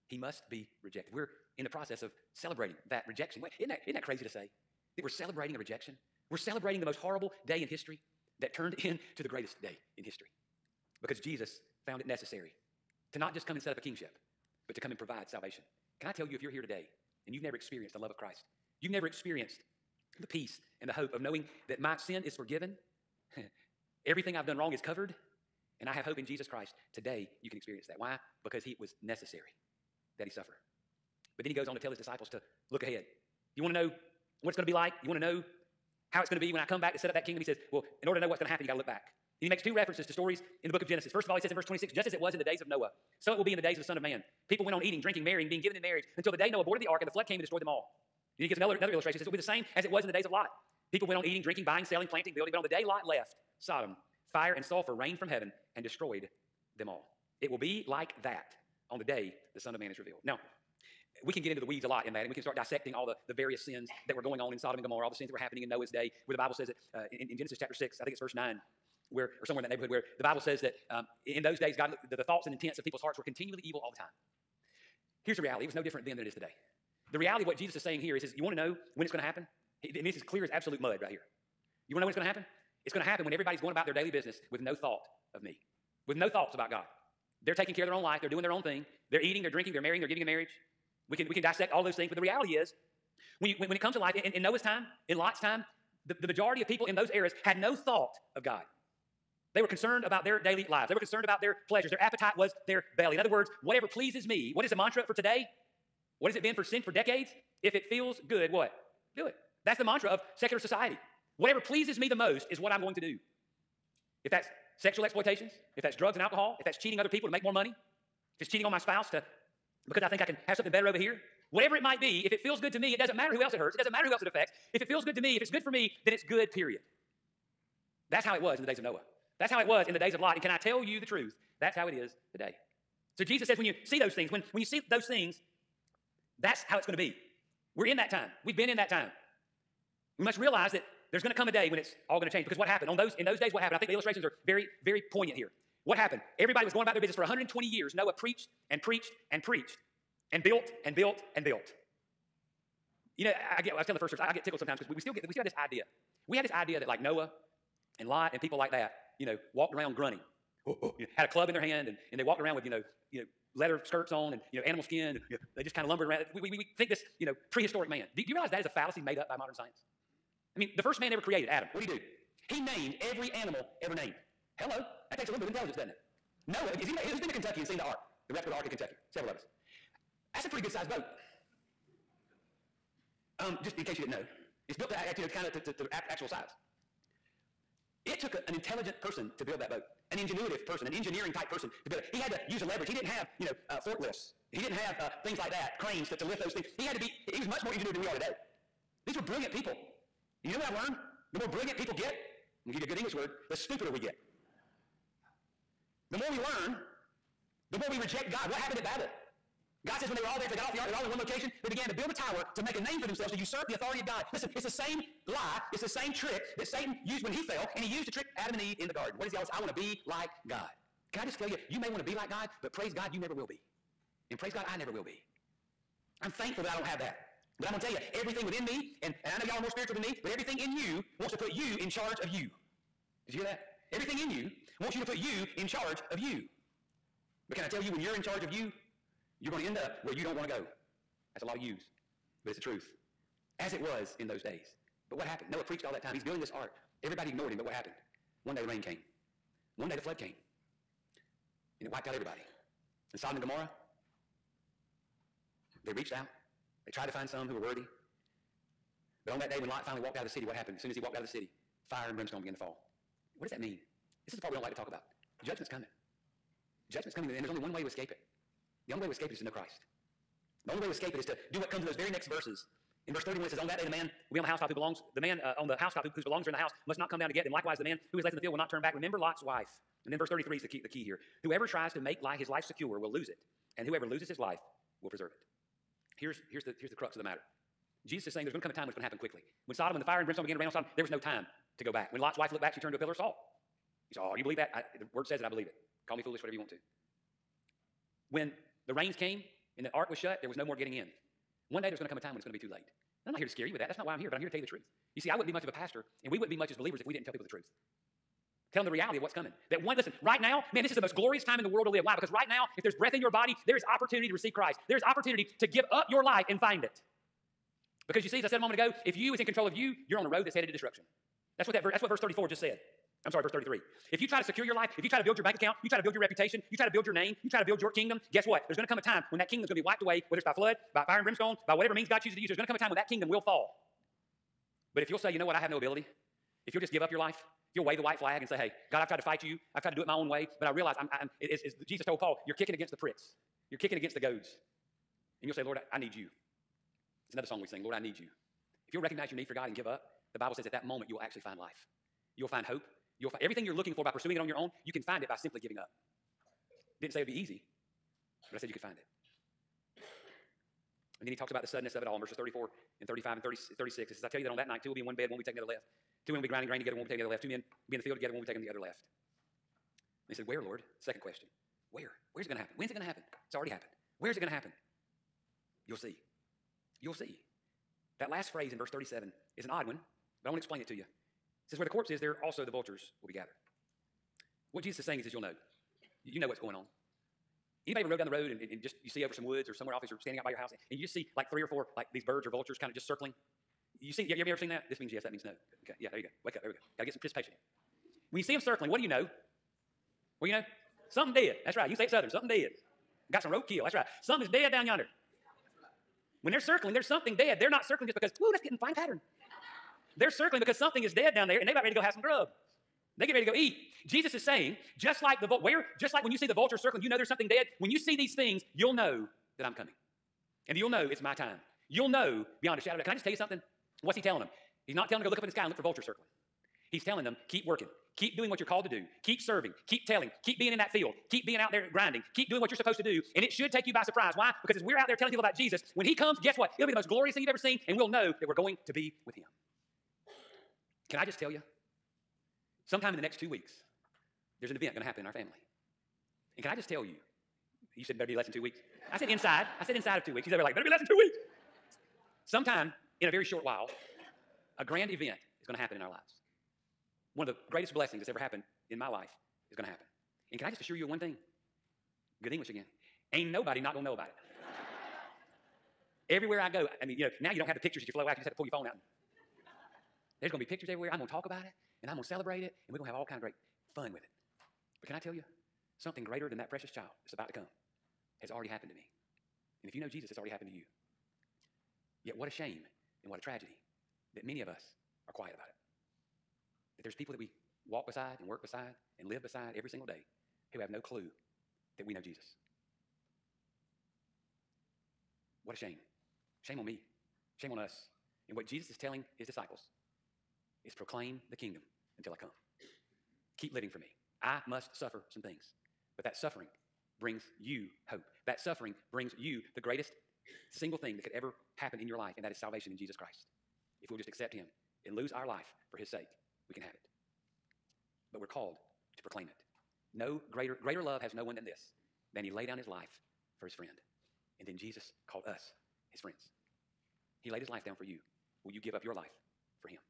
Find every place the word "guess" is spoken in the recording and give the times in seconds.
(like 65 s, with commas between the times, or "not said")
328 s, 436 s.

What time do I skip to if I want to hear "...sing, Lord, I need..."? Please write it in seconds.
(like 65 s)
347 s.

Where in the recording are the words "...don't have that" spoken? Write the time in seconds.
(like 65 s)
226 s.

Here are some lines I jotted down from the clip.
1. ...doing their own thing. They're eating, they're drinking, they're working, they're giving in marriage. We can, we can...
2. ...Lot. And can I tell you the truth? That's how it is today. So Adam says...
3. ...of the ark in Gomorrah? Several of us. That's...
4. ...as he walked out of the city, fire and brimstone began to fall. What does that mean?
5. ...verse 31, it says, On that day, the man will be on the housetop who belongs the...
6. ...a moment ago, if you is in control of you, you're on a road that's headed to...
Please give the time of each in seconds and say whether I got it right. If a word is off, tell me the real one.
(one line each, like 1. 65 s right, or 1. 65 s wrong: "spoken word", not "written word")
1. 88 s wrong: "marrying", not "working"
2. 130 s wrong: "Jesus", not "Adam"
3. 178 s wrong: "Kentucky", not "Gomorrah"
4. 260 s right
5. 273 s right
6. 318 s right.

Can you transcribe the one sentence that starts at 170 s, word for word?
I mean, the first man ever created, Adam, what did he do?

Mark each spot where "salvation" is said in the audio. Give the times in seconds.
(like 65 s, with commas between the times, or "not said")
15 s, 512 s.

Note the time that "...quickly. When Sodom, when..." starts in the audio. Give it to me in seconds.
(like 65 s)
289 s.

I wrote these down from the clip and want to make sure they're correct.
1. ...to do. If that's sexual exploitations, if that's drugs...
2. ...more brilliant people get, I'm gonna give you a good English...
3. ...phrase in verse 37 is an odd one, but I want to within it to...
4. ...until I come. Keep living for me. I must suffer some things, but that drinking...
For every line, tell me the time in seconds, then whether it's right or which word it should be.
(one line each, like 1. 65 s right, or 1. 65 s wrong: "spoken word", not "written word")
1. 112 s right
2. 201 s right
3. 378 s wrong: "explain", not "within"
4. 502 s wrong: "suffering", not "drinking".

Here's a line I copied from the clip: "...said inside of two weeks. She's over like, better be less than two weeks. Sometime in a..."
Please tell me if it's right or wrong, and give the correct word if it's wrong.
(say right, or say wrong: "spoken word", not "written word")
right.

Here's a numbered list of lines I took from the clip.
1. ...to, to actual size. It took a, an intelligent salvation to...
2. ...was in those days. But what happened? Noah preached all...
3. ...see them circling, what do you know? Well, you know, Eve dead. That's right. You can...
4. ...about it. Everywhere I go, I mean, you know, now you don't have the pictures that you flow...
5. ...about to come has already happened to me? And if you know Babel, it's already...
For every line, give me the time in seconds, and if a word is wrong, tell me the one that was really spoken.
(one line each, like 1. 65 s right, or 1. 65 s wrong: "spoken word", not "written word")
1. 185 s wrong: "person", not "salvation"
2. 243 s right
3. 398 s wrong: "Something", not "Eve"
4. 464 s right
5. 477 s wrong: "Jesus", not "Babel".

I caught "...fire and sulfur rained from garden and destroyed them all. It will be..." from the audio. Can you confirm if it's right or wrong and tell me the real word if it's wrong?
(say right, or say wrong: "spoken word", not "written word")
wrong: "heaven", not "garden".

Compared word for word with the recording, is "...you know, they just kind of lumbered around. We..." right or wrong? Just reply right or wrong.
right.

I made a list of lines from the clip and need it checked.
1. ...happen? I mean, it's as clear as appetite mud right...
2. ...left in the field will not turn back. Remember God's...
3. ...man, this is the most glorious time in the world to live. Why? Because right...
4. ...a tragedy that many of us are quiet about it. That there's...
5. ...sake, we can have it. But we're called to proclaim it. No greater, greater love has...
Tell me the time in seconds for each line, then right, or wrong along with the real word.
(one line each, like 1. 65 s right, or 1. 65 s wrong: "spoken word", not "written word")
1. 79 s wrong: "absolute", not "appetite"
2. 278 s wrong: "Lot", not "God"
3. 310 s right
4. 483 s right
5. 516 s right.